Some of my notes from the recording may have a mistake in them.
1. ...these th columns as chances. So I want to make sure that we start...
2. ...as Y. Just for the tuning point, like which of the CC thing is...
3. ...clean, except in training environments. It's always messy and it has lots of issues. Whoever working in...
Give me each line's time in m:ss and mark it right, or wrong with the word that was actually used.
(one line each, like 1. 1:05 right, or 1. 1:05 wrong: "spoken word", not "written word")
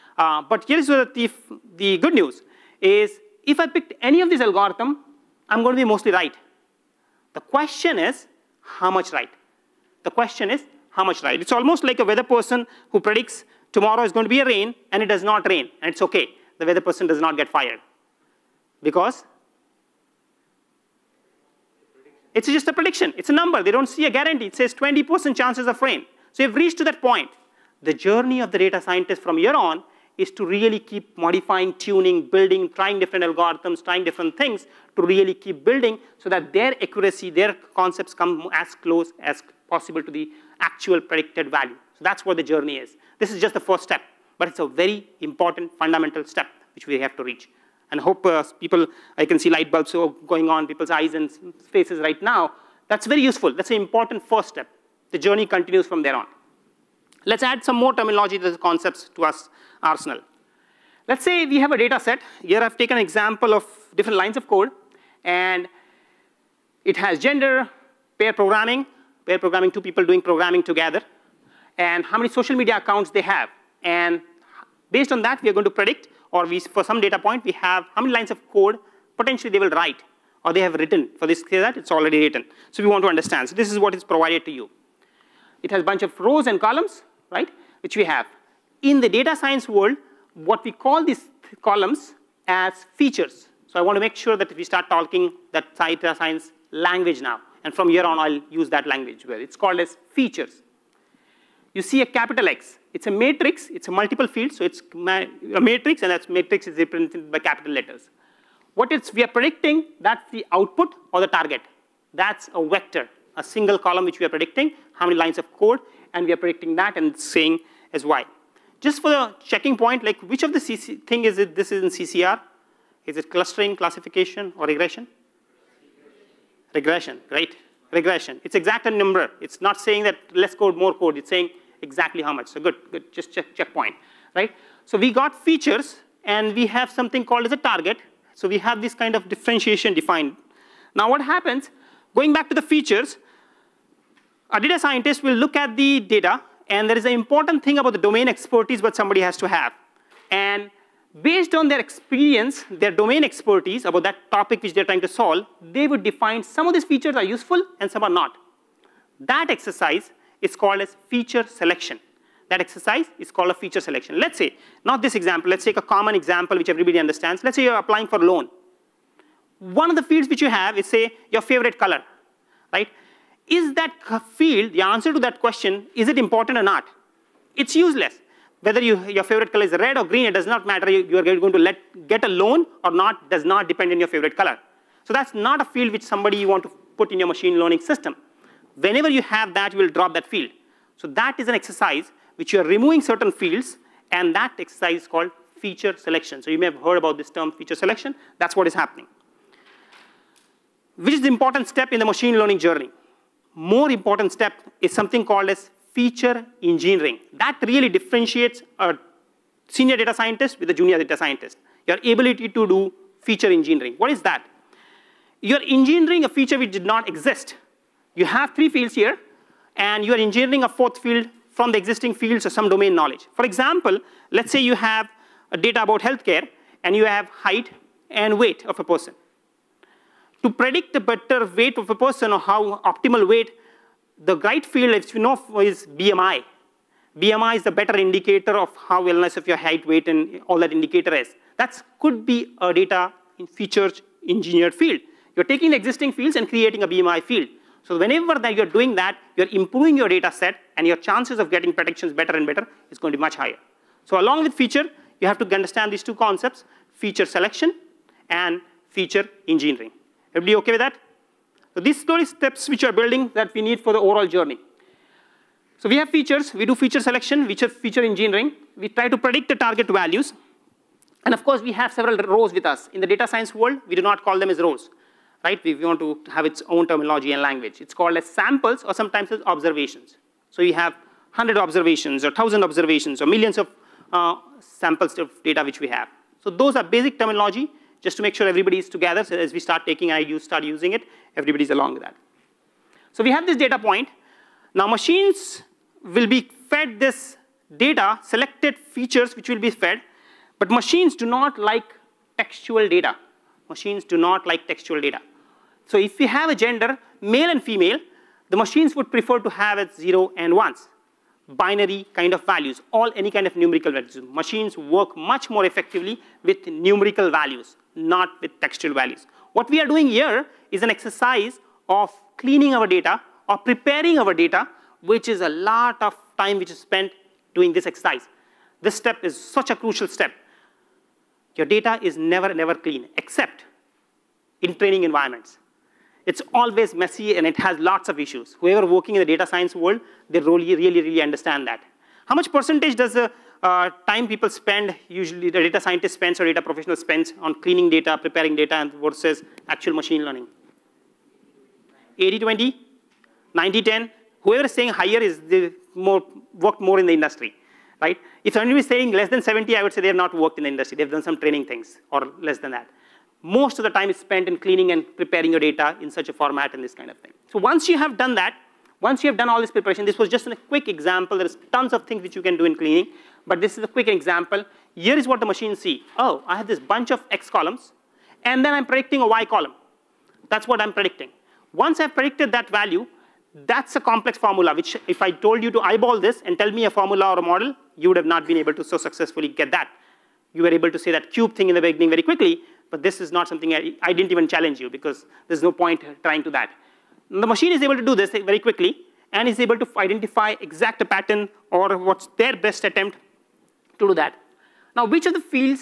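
1. 1:31 wrong: "features", not "chances"
2. 1:57 wrong: "checking", not "tuning"
3. 5:32 right.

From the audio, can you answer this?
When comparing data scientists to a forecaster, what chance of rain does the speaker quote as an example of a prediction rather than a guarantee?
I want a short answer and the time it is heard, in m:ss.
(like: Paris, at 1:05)
20%, at 0:24.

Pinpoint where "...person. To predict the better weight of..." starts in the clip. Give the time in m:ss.
3:48.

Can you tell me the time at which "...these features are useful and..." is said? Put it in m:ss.
2:36.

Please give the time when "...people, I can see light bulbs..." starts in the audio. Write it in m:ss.
0:48.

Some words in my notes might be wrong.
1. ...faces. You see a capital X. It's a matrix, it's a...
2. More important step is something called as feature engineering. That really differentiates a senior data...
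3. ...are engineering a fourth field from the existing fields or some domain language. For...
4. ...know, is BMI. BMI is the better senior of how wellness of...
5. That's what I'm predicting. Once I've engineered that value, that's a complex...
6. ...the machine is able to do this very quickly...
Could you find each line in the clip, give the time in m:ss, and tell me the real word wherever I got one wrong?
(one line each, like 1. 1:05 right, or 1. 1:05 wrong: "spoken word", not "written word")
1. 1:40 wrong: "features", not "faces"
2. 3:23 right
3. 3:40 wrong: "knowledge", not "language"
4. 3:55 wrong: "indicator", not "senior"
5. 6:20 wrong: "predicted", not "engineered"
6. 6:37 right.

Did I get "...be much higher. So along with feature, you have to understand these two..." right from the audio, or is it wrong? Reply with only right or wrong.
right.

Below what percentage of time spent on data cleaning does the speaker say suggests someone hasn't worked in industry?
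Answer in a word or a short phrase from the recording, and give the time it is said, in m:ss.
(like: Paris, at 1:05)
70, at 5:59.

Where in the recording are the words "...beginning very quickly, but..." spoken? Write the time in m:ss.
6:31.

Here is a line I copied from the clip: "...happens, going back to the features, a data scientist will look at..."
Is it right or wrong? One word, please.
right.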